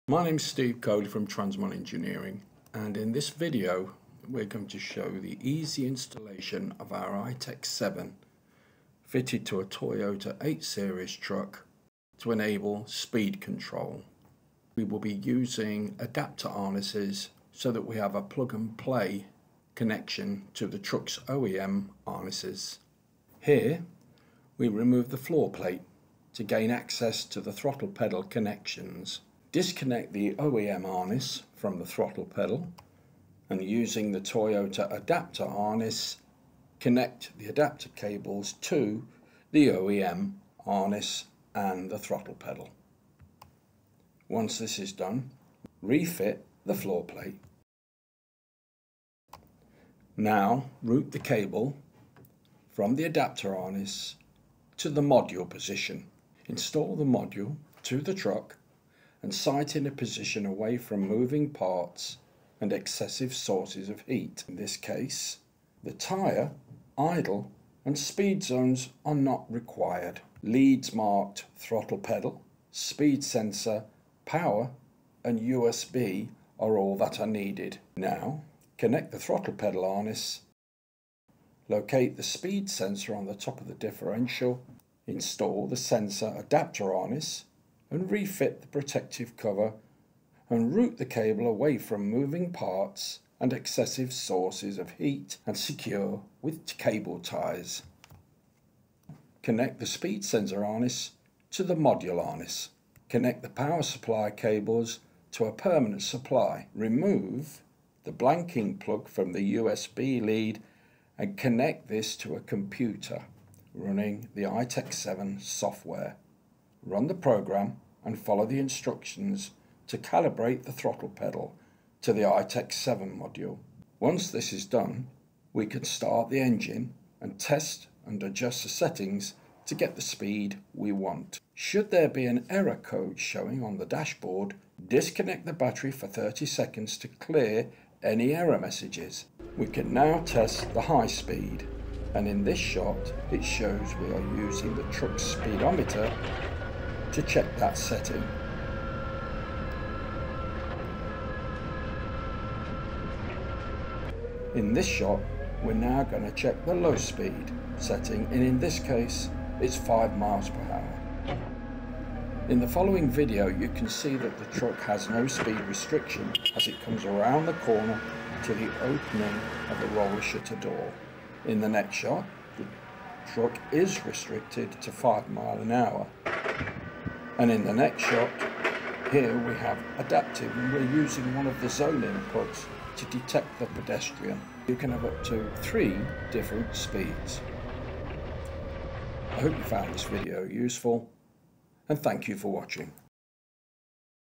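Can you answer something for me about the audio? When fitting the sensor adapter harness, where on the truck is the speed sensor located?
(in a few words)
Top of the differential.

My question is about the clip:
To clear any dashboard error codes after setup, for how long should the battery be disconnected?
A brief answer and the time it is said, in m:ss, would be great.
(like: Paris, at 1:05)
30 seconds, at 2:16.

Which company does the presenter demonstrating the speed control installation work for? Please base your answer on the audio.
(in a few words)
Transmon Engineering.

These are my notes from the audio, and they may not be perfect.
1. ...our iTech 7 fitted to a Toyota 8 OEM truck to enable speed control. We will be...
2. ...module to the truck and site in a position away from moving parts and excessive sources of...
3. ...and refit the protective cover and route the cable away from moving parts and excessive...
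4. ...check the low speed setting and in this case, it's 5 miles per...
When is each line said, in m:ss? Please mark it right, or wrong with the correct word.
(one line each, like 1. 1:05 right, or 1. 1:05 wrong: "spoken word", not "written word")
1. 0:06 wrong: "Series", not "OEM"
2. 0:57 right
3. 1:27 right
4. 2:36 right.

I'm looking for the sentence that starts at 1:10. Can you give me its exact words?
Leads marked throttle pedal, speed sensor, power, and USB are all that are needed.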